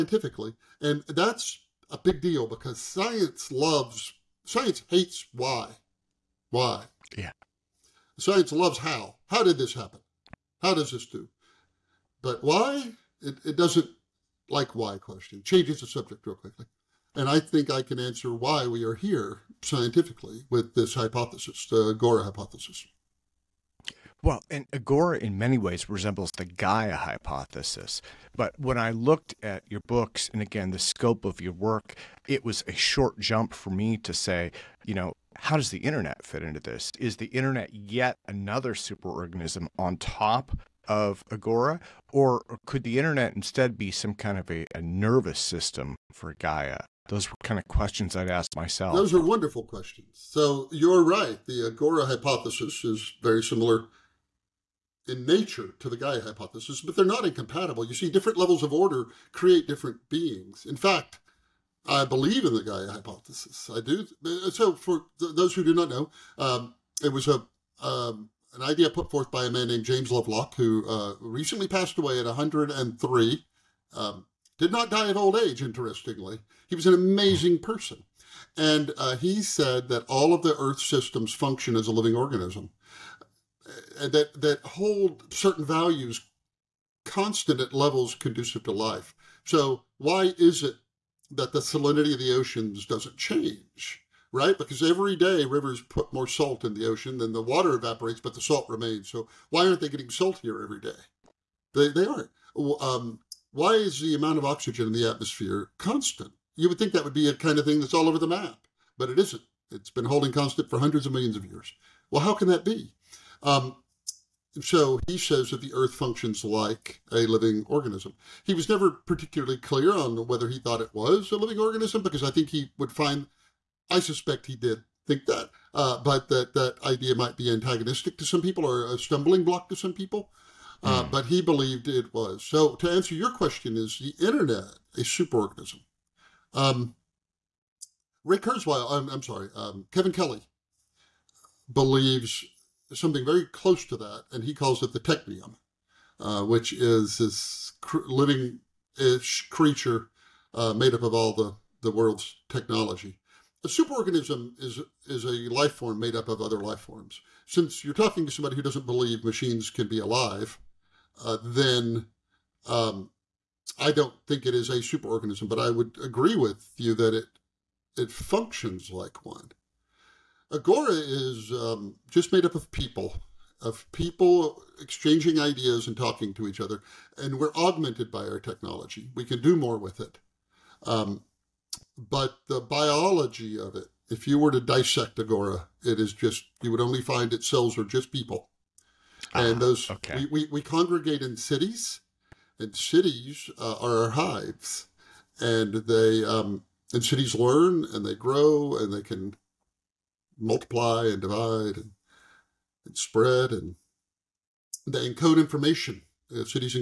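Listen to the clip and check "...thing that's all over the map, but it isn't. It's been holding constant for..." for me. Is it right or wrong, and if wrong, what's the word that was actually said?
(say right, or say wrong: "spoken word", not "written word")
right.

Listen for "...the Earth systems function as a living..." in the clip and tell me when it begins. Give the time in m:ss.
1:20.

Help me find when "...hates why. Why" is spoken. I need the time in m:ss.
0:04.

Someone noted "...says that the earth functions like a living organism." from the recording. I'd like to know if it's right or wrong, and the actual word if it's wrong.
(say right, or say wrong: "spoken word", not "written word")
right.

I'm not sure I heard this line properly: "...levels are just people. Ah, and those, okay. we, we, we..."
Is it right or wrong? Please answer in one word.
wrong.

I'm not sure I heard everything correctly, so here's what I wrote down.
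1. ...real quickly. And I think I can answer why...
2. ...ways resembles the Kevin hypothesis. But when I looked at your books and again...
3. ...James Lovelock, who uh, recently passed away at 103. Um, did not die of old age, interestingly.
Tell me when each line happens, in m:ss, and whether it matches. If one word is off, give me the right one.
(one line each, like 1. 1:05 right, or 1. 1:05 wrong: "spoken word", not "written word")
1. 0:16 right
2. 0:25 wrong: "Gaia", not "Kevin"
3. 1:09 right.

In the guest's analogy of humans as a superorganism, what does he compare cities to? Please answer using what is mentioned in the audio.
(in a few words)
hives.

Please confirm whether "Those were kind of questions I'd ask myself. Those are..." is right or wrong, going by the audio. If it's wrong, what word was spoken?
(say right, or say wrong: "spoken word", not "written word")
right.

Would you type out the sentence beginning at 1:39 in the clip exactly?
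So why aren't they getting saltier every day?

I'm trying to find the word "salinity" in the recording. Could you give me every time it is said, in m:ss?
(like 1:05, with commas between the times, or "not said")
1:31.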